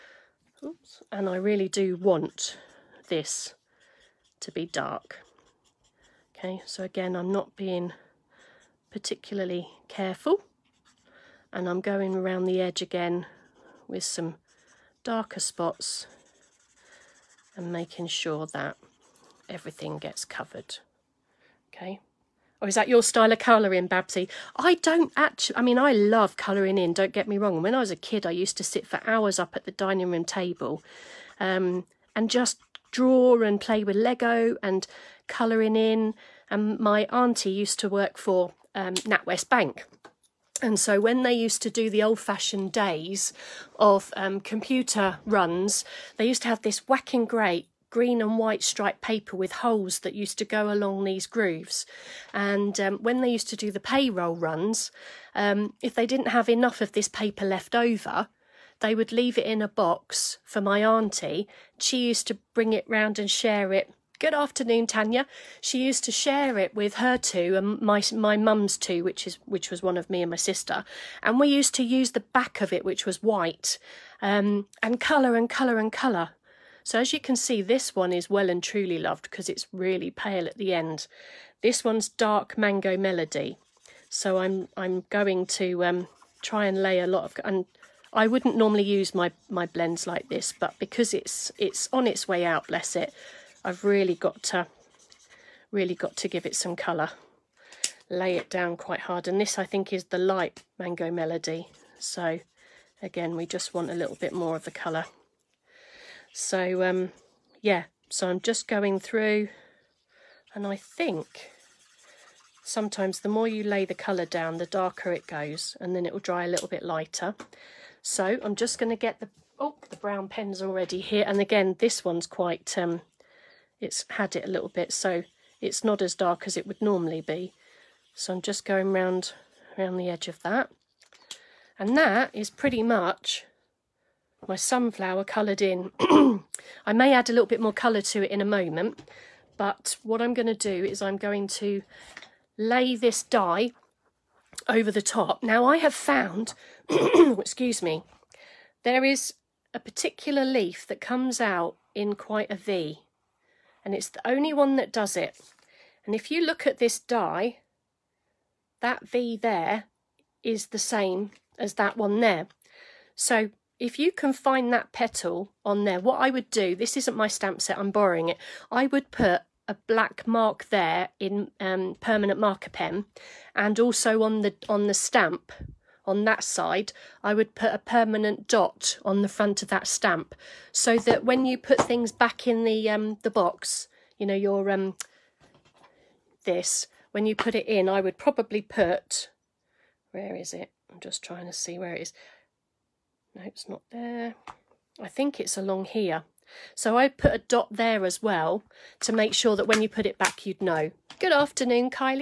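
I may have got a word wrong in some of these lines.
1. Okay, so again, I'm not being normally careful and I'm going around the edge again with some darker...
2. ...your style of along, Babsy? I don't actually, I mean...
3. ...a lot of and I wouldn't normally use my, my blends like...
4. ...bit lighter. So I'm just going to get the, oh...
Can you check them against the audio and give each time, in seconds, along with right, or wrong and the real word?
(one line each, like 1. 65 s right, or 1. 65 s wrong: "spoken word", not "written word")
1. 6 s wrong: "particularly", not "normally"
2. 22 s wrong: "colouring", not "along"
3. 86 s right
4. 116 s right.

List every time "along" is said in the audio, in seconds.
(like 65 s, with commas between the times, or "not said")
50 s, 195 s.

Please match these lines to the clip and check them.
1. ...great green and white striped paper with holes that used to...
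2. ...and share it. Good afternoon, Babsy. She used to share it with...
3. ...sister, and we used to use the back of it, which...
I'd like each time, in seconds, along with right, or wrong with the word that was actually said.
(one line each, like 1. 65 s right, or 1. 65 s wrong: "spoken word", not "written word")
1. 47 s right
2. 63 s wrong: "Tanya", not "Babsy"
3. 70 s right.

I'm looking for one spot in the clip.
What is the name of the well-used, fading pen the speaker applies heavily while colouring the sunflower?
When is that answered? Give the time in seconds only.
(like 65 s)
82 s.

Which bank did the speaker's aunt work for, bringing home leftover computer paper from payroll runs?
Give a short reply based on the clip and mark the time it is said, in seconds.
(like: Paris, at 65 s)
NatWest, at 38 s.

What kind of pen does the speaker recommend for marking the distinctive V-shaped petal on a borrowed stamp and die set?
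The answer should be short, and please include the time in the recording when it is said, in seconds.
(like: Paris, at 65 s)
permanent marker, at 172 s.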